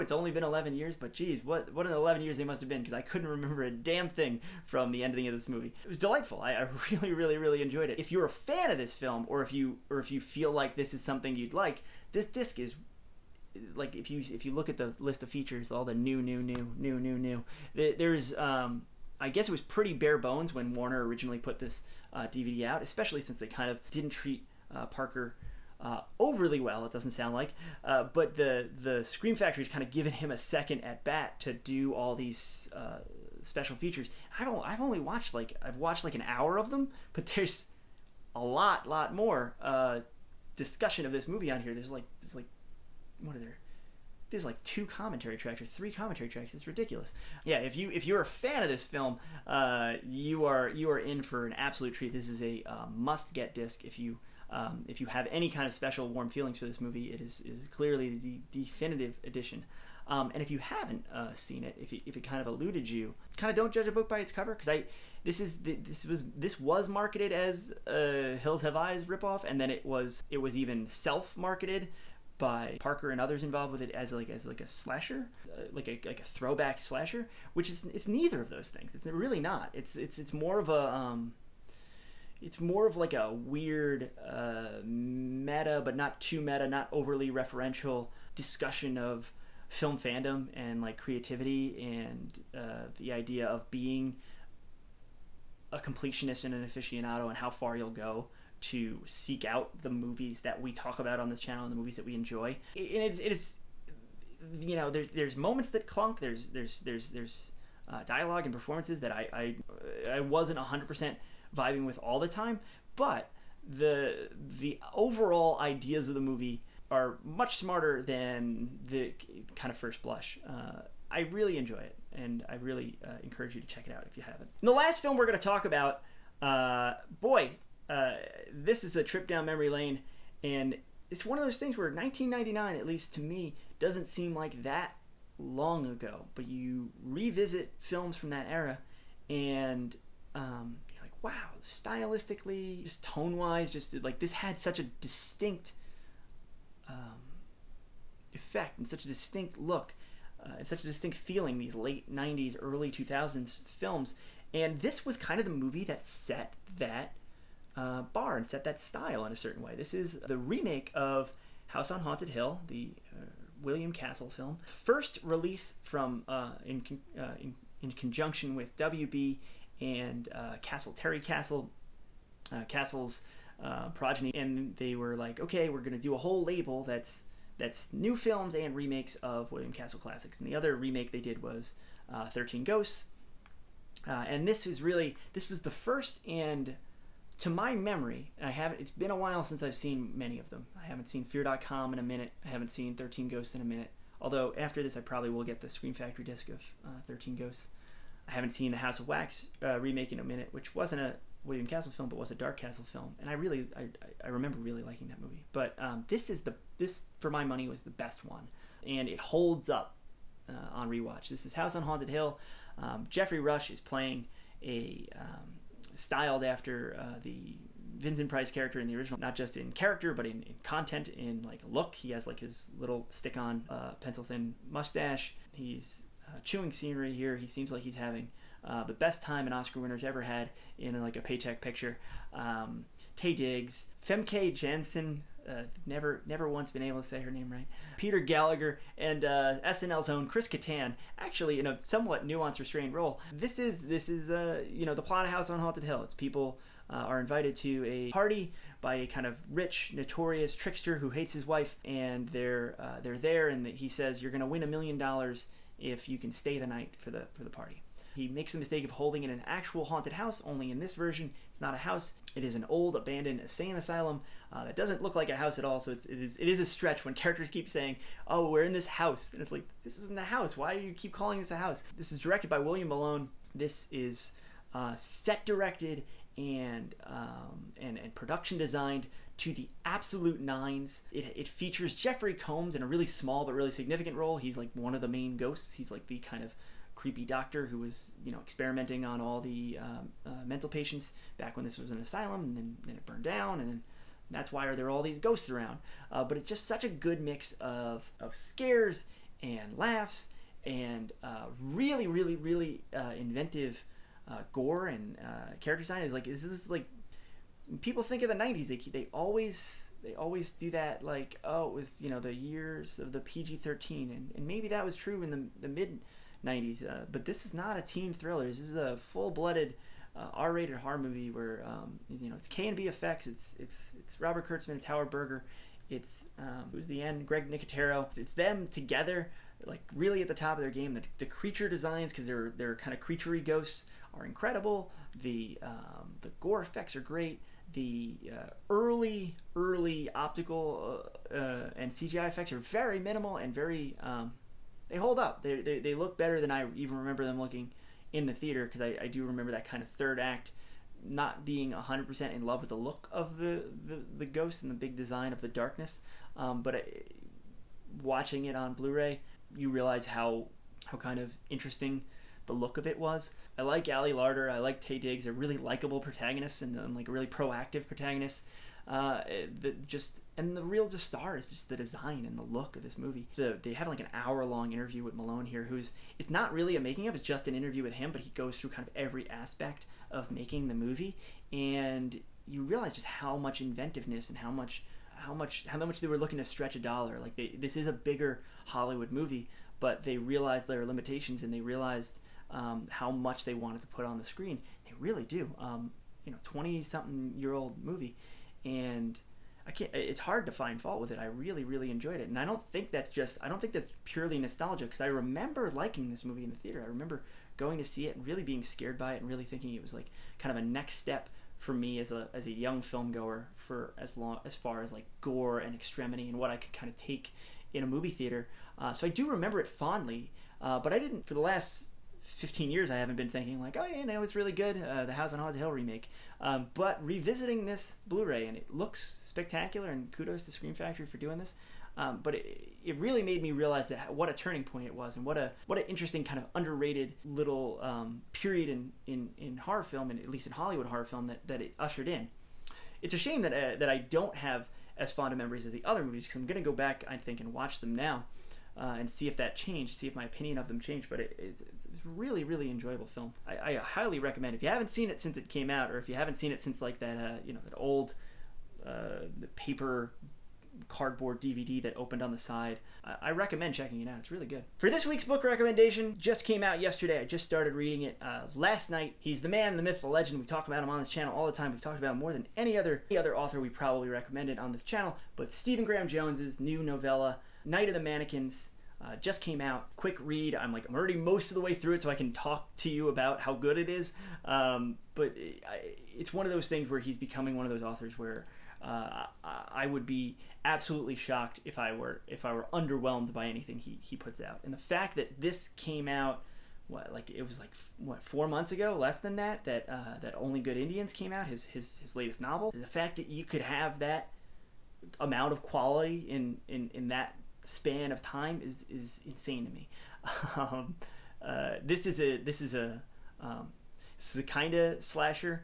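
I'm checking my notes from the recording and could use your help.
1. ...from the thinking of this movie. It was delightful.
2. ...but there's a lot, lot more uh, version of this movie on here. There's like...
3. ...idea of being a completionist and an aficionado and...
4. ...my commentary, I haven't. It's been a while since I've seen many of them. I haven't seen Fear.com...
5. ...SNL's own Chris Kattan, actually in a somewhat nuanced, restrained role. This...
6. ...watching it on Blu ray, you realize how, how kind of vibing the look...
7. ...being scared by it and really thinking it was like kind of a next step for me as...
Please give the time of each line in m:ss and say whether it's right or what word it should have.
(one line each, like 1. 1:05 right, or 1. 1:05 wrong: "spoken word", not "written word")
1. 0:04 wrong: "ending", not "thinking"
2. 0:37 wrong: "discussion", not "version"
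3. 1:33 right
4. 3:07 wrong: "memory", not "commentary"
5. 3:59 right
6. 5:58 wrong: "interesting", not "vibing"
7. 6:48 right.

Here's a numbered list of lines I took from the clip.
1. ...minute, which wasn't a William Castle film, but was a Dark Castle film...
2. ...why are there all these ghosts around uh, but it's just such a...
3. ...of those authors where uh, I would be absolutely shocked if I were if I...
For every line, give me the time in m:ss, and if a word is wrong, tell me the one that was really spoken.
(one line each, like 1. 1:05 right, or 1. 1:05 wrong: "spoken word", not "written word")
1. 3:20 right
2. 4:54 right
3. 8:07 right.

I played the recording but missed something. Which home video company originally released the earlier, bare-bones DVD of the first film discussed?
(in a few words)
Warner.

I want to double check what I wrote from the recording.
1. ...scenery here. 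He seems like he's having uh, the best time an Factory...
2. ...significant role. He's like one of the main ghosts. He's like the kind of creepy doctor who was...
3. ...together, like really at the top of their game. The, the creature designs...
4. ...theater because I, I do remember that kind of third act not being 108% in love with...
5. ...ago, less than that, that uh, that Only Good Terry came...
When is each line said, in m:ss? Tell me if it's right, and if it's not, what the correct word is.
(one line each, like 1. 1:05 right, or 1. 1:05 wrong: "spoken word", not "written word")
1. 3:46 wrong: "Oscar", not "Factory"
2. 4:43 right
3. 5:28 right
4. 5:48 wrong: "100", not "108"
5. 8:18 wrong: "Indians", not "Terry".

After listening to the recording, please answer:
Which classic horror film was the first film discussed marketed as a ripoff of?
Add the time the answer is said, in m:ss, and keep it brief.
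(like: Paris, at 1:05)
Hills Have Eyes, at 1:08.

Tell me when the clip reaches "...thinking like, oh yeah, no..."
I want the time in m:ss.
7:03.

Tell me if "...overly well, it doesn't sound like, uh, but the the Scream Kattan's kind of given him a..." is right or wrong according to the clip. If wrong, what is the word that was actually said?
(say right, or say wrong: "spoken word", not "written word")
wrong: "Factory", not "Kattan".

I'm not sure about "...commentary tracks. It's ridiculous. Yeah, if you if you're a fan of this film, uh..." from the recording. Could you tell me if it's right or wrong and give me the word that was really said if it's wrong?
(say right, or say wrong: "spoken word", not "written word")
right.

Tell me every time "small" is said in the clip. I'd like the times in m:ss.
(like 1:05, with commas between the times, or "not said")
4:43.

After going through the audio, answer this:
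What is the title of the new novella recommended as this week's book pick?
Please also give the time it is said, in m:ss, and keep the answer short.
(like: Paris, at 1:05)
Night of the Mannequins, at 7:57.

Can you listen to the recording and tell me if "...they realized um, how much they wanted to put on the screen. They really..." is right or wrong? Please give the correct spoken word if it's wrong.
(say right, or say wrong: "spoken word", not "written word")
right.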